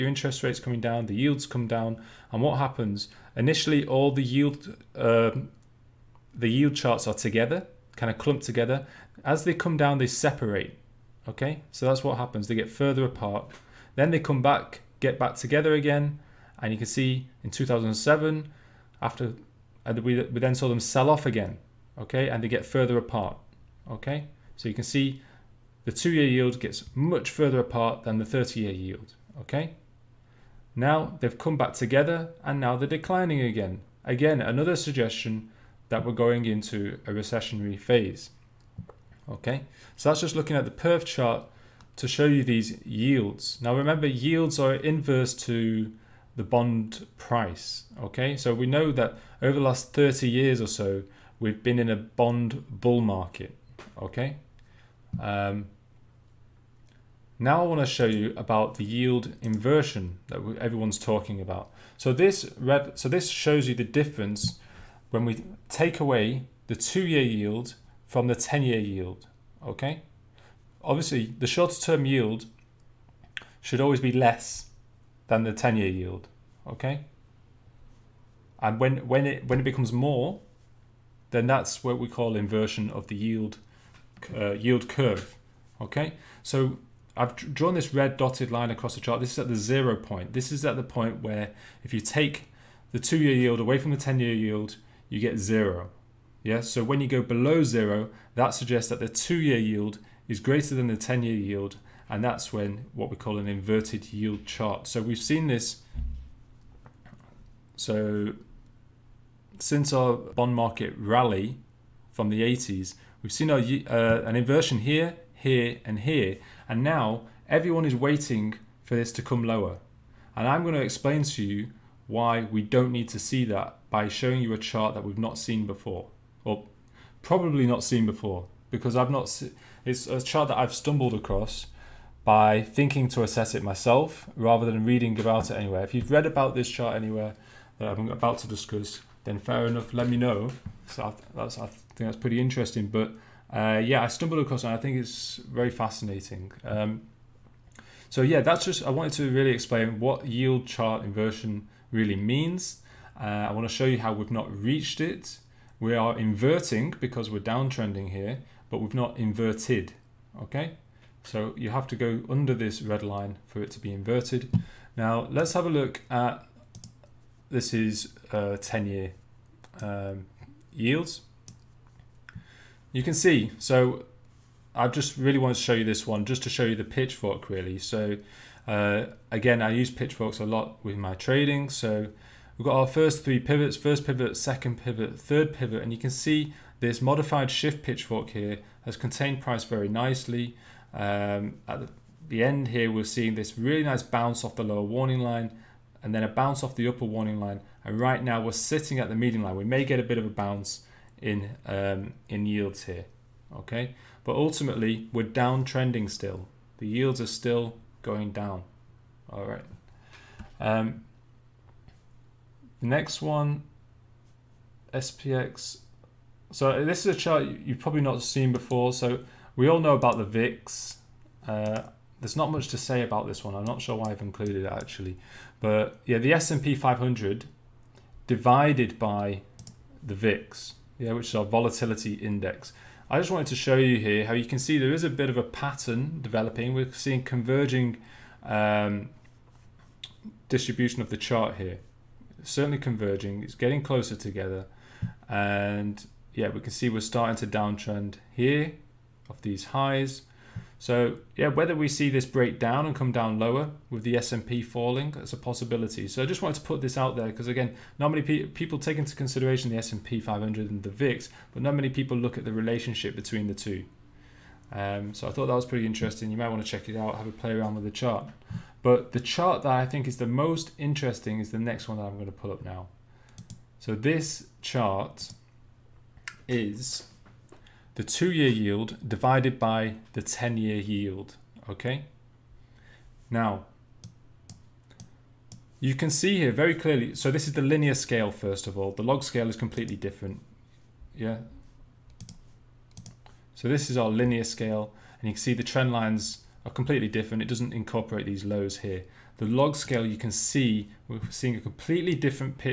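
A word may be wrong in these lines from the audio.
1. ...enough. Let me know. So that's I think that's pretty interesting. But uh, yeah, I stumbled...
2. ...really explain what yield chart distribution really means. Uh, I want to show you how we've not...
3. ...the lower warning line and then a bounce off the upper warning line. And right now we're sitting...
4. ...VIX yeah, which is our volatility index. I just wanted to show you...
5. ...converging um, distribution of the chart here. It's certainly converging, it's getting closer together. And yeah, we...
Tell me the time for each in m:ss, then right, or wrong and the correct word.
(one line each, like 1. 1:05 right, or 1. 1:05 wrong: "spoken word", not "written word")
1. 2:19 right
2. 2:29 wrong: "inversion", not "distribution"
3. 3:14 right
4. 3:50 right
5. 3:57 right.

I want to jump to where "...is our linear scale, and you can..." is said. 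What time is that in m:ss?
4:53.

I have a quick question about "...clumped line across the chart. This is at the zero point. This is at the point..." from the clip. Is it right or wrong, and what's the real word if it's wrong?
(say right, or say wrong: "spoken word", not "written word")
wrong: "dotted", not "clumped".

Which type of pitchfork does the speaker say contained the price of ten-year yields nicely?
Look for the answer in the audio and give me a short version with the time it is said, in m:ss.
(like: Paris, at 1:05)
modified shift pitchfork, at 3:07.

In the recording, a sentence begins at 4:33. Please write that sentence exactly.
So this chart is the two-year yield divided by the 10-year yield, okay?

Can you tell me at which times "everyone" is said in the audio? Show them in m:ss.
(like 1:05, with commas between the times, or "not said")
1:00, 1:57.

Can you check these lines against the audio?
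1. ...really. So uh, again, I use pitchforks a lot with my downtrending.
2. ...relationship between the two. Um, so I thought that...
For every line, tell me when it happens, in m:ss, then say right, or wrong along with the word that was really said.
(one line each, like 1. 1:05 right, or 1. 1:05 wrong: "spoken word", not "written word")
1. 2:57 wrong: "trading", not "downtrending"
2. 4:22 right.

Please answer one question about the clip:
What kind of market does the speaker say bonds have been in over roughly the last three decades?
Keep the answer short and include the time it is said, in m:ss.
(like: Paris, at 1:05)
bond bull market, at 0:51.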